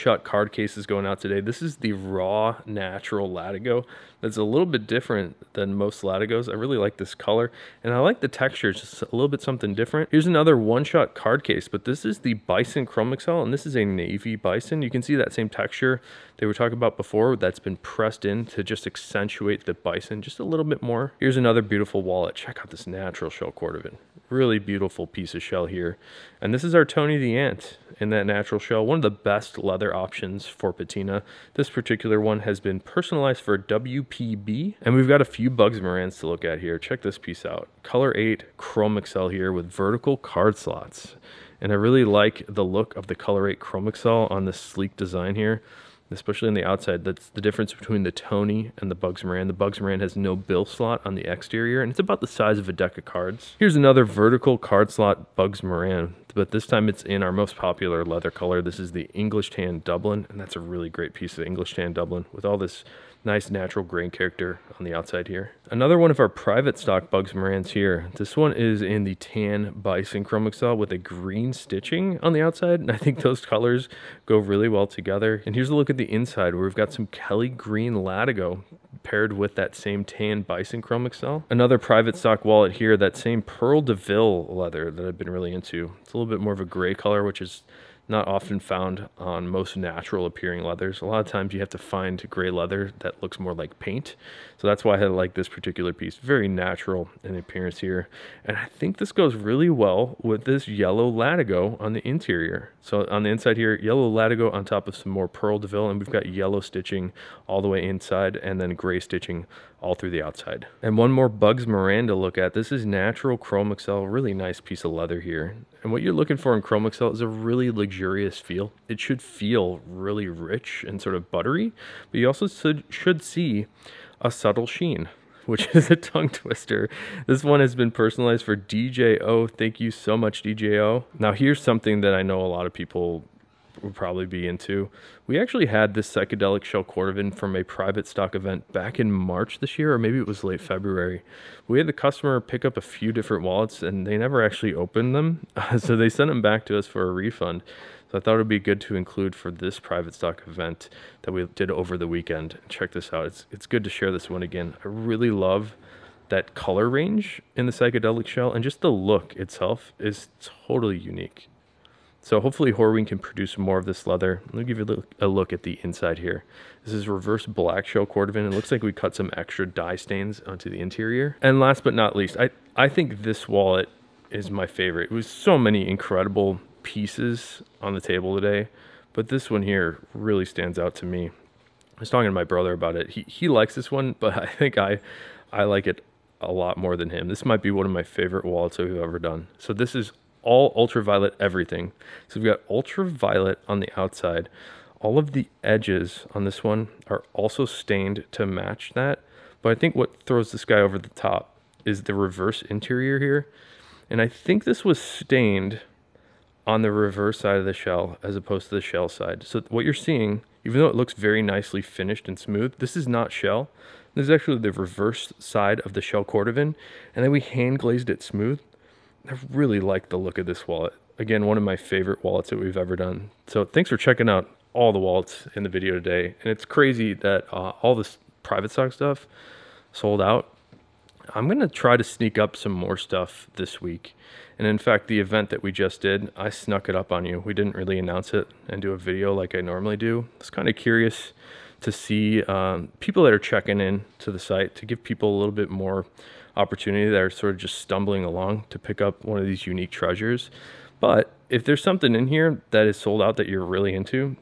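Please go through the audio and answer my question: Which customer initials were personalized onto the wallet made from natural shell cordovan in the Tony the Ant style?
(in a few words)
WP PB.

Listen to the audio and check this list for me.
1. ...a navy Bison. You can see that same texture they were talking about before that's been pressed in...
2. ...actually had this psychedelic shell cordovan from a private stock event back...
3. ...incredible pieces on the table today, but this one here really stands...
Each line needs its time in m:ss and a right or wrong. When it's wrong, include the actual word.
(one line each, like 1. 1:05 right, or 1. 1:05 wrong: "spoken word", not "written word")
1. 0:13 right
2. 2:15 right
3. 2:55 right.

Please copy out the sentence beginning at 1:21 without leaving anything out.
Another private stock wallet here, that same Pearl DeVille leather that I've been really into.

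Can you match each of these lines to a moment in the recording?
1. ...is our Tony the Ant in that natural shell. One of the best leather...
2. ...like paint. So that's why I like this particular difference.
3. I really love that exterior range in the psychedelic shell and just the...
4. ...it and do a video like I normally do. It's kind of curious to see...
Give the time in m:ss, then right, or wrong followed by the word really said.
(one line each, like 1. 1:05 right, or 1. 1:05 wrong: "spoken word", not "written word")
1. 0:26 right
2. 1:33 wrong: "piece", not "difference"
3. 2:34 wrong: "color", not "exterior"
4. 3:58 right.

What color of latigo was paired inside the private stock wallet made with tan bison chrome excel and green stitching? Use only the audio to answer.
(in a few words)
Kelly green.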